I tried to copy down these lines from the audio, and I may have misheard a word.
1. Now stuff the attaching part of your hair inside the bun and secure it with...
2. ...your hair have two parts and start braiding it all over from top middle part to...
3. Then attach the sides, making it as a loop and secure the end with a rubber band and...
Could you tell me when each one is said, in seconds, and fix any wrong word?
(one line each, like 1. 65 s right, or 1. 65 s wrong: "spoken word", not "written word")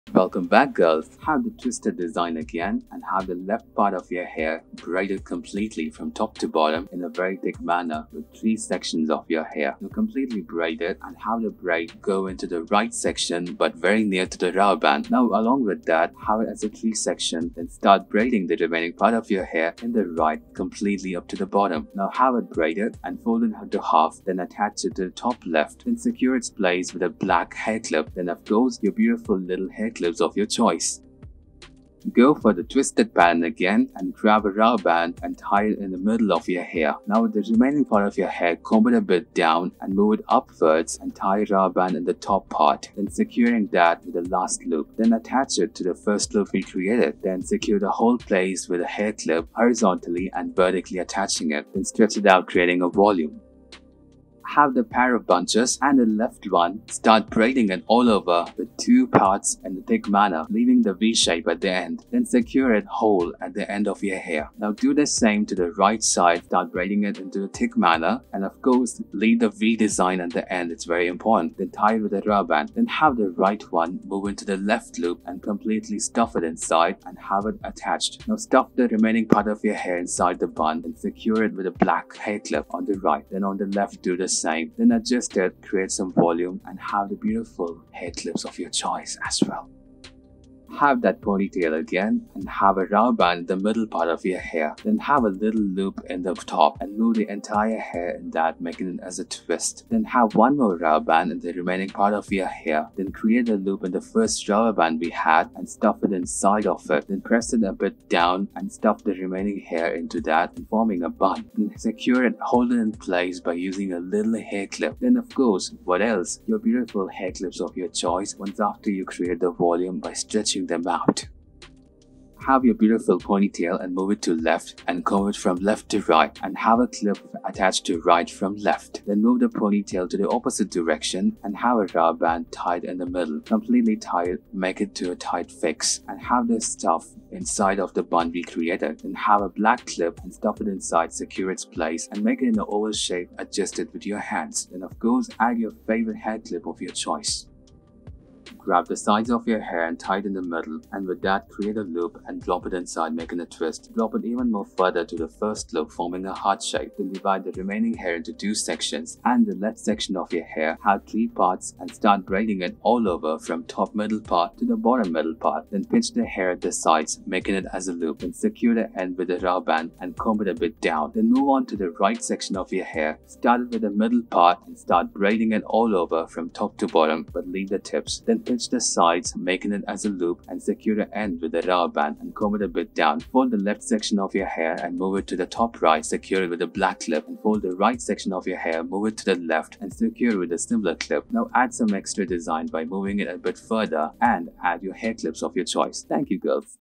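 1. 78 s wrong: "remaining", not "attaching"
2. 160 s wrong: "three", not "two"
3. 178 s right.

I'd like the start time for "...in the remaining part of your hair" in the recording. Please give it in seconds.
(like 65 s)
101 s.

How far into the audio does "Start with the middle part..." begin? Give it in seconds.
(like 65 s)
173 s.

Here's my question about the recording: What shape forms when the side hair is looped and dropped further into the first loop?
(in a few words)
heart.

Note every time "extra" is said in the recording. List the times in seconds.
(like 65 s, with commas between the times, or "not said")
191 s.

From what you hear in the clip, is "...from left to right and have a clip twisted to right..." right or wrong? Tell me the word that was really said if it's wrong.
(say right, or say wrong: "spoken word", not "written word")
wrong: "attached", not "twisted".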